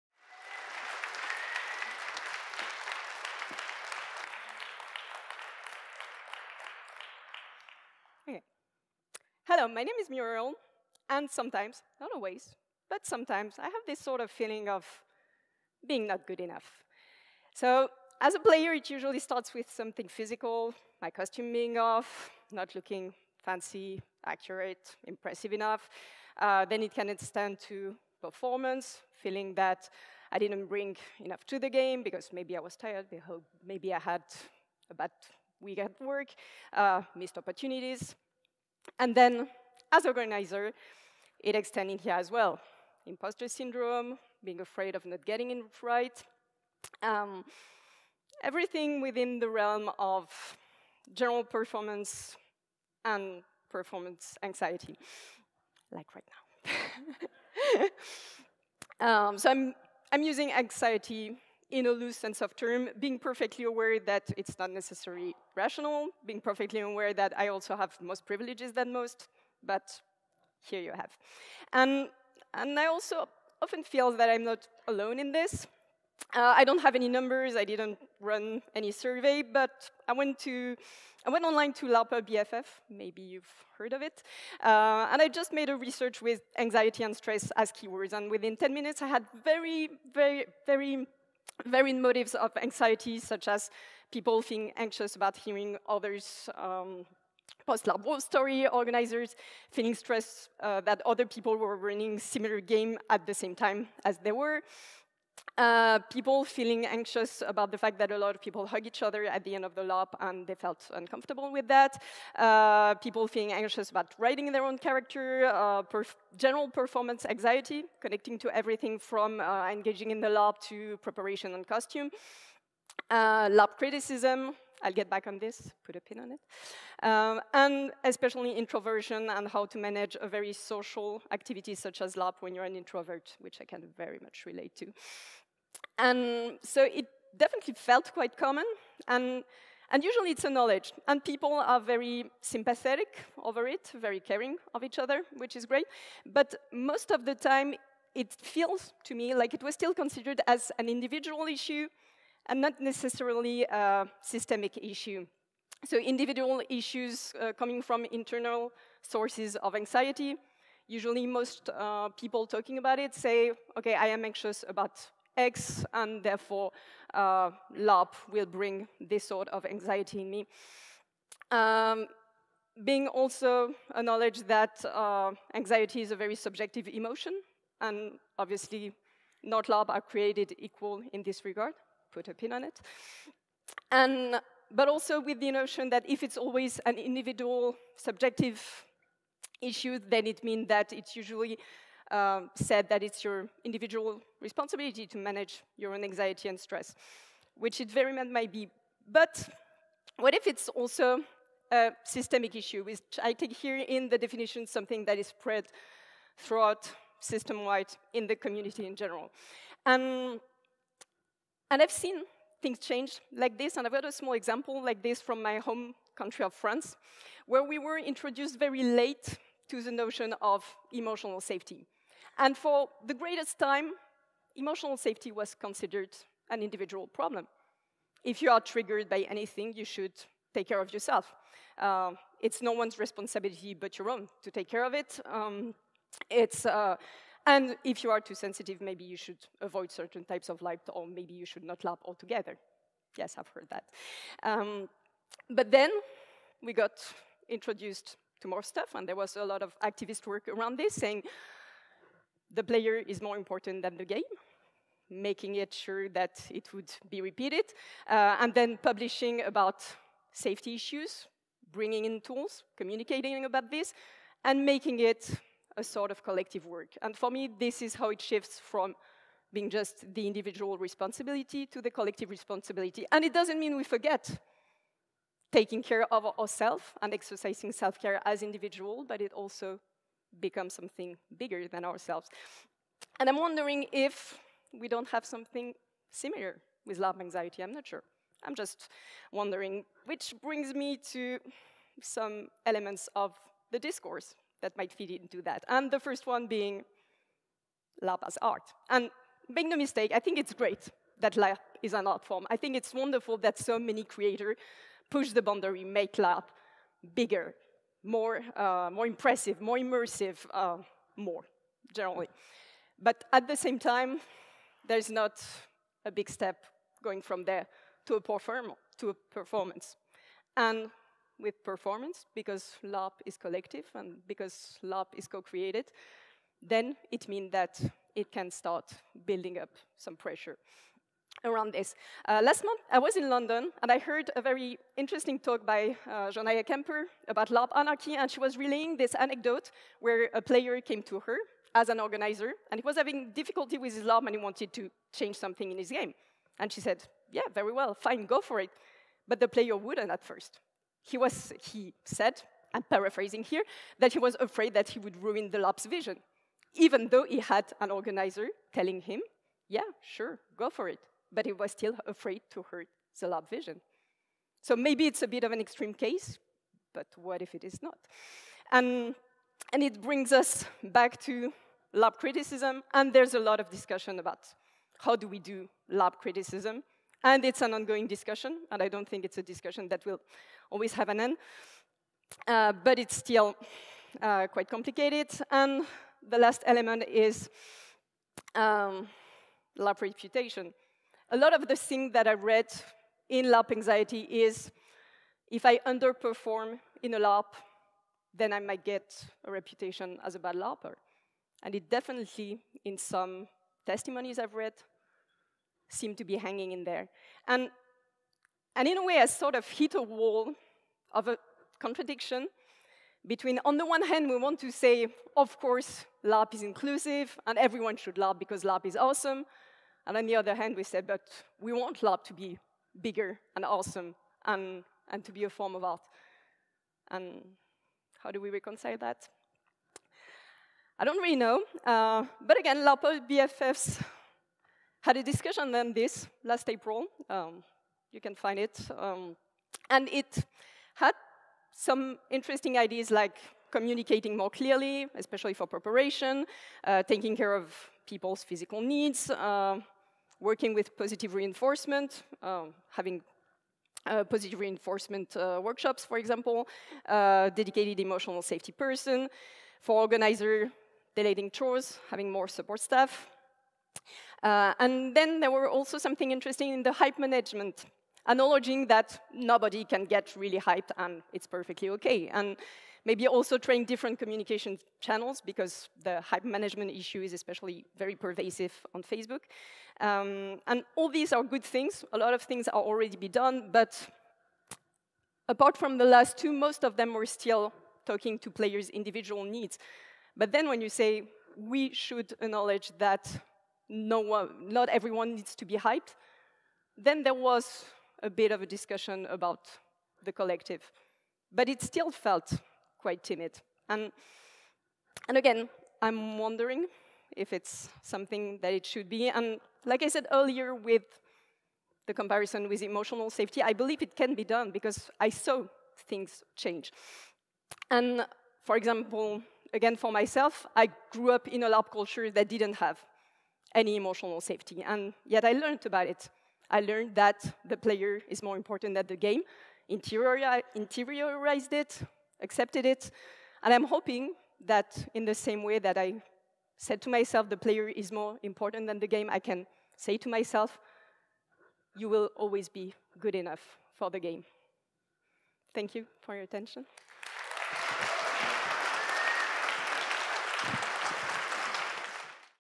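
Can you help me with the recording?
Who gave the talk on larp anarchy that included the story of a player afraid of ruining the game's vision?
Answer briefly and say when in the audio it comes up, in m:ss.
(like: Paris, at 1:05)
Jonaya Kemper, at 5:36.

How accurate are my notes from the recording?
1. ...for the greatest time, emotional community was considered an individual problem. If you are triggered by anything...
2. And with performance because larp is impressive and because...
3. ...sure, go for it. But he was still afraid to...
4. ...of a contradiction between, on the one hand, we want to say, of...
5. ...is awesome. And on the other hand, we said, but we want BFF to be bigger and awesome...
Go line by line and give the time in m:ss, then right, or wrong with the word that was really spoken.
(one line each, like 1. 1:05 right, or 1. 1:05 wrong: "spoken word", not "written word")
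1. 3:42 wrong: "safety", not "community"
2. 5:20 wrong: "collective", not "impressive"
3. 6:00 right
4. 6:51 right
5. 6:58 wrong: "LARP", not "BFF".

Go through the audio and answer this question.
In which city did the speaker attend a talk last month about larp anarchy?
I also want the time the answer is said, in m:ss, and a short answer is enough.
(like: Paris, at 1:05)
London, at 5:33.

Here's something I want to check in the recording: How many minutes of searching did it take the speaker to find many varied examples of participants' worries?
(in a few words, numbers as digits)
10.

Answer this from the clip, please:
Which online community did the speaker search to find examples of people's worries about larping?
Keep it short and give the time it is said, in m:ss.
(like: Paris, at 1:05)
LARPA BFF, at 1:21.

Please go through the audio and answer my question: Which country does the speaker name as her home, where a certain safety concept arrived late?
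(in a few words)
France.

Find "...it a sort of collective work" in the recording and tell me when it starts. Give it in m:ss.
4:24.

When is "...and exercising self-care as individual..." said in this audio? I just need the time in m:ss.
4:37.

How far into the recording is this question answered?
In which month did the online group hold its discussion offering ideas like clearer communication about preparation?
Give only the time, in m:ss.
7:16.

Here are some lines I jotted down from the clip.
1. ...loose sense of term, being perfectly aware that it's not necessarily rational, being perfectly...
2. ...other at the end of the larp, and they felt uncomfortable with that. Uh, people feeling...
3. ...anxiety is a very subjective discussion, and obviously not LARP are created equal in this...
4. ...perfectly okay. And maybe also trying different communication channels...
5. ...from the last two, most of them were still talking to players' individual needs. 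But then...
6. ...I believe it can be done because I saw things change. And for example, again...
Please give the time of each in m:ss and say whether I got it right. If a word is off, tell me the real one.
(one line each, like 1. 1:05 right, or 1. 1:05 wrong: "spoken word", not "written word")
1. 1:01 right
2. 1:49 right
3. 2:55 wrong: "emotion", not "discussion"
4. 7:51 right
5. 8:05 right
6. 8:33 right.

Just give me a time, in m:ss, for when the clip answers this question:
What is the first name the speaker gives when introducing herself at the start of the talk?
0:10.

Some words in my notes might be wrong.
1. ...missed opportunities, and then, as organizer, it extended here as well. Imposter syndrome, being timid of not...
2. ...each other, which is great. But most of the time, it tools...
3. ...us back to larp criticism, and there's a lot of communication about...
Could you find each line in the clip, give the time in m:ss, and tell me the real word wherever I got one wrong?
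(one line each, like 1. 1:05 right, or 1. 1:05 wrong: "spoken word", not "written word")
1. 0:37 wrong: "afraid", not "timid"
2. 2:24 wrong: "feels", not "tools"
3. 6:10 wrong: "discussion", not "communication".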